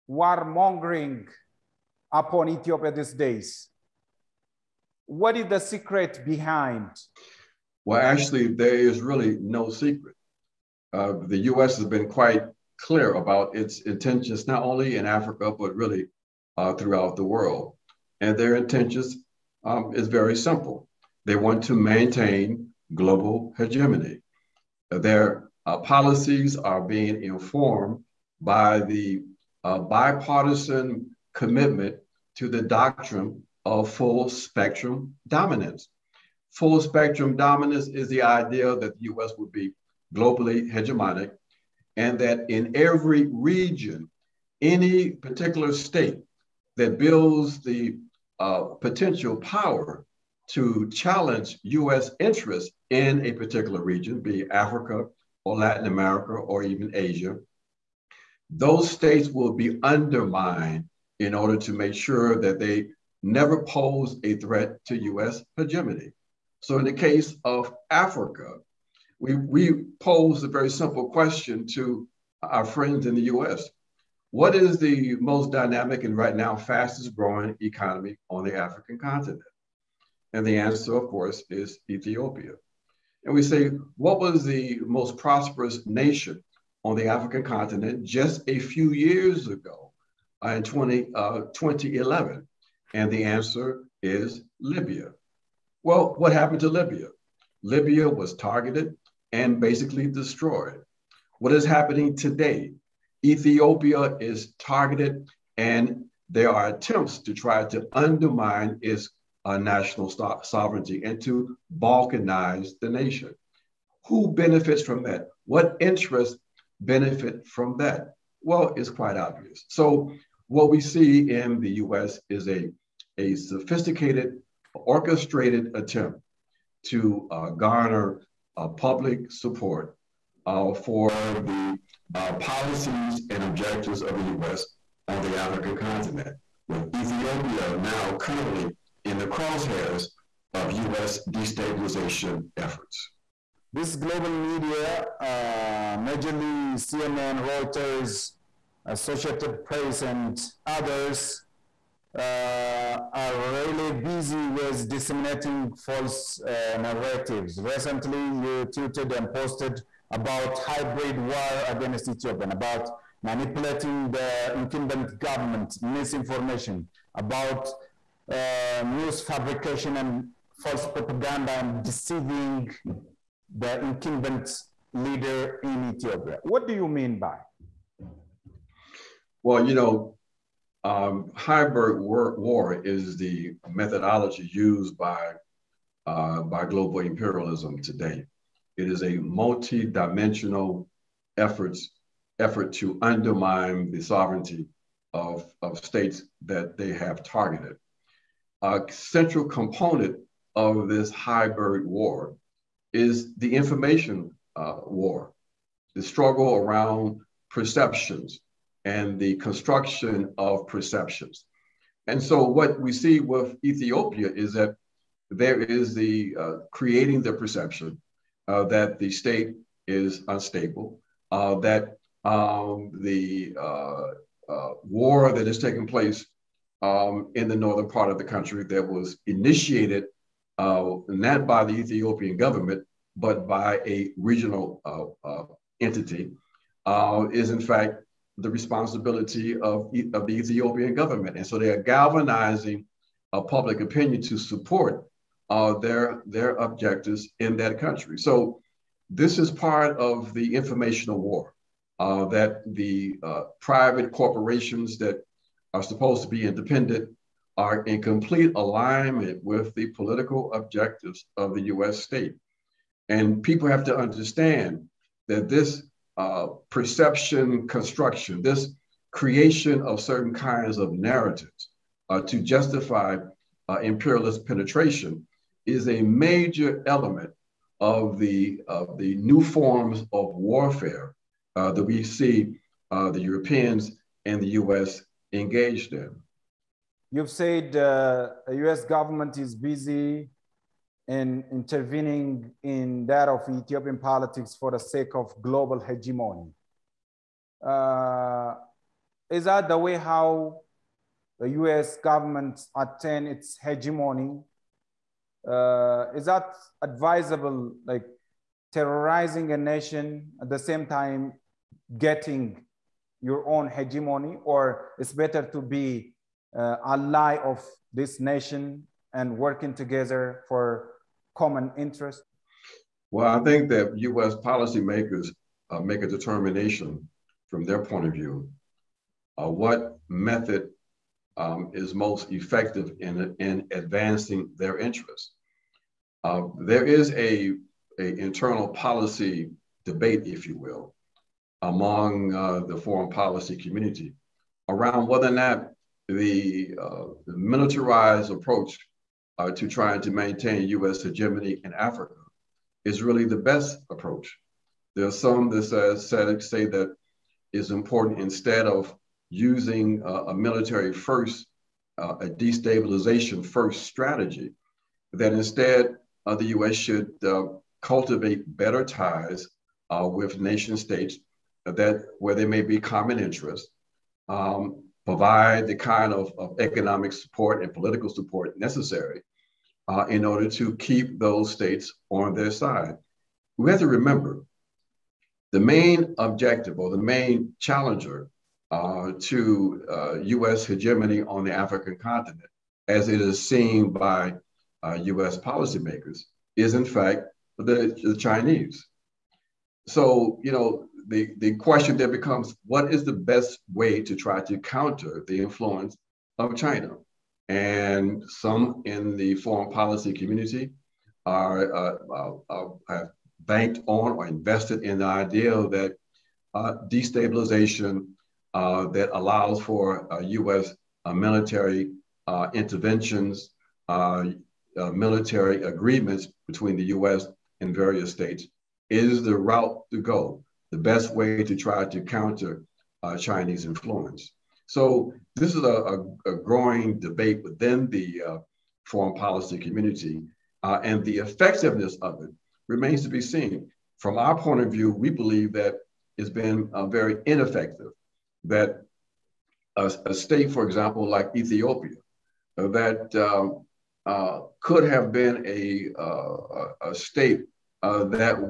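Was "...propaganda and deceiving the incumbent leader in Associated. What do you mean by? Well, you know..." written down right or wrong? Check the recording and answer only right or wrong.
wrong.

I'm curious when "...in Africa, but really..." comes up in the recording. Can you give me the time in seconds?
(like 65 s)
14 s.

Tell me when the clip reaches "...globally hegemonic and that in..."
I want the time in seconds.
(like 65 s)
40 s.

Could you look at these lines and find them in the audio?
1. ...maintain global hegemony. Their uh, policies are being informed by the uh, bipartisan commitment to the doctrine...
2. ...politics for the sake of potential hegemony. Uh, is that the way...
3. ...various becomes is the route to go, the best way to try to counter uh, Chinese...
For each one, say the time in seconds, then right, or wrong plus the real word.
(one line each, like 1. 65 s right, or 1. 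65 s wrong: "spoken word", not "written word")
1. 21 s right
2. 293 s wrong: "global", not "potential"
3. 427 s wrong: "states", not "becomes".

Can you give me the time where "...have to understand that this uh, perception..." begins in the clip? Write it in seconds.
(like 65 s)
263 s.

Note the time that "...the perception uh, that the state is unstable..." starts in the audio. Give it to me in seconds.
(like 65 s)
217 s.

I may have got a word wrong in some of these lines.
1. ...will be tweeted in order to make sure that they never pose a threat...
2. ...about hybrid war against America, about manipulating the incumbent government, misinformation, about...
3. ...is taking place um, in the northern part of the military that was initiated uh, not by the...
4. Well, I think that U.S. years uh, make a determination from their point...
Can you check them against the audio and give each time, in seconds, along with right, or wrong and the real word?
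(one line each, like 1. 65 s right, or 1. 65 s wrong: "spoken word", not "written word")
1. 59 s wrong: "undermined", not "tweeted"
2. 160 s wrong: "Ethiopia", not "America"
3. 225 s wrong: "country", not "military"
4. 323 s wrong: "policymakers", not "years".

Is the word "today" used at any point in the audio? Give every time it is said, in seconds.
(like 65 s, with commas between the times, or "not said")
102 s, 187 s.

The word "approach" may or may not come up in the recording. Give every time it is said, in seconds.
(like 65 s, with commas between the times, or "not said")
348 s, 353 s.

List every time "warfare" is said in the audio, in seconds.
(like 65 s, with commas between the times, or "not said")
280 s.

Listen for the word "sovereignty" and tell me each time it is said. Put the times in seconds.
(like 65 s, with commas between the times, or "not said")
110 s, 194 s.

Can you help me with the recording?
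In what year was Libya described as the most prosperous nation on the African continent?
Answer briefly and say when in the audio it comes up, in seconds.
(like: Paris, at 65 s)
2011, at 91 s.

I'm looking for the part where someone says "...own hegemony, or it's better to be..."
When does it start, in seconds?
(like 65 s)
313 s.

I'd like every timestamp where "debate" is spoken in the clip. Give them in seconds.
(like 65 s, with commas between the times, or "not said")
339 s, 436 s.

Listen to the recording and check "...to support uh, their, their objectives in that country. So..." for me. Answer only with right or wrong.
right.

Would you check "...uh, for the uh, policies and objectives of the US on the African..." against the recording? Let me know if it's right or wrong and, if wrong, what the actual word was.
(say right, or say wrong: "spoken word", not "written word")
right.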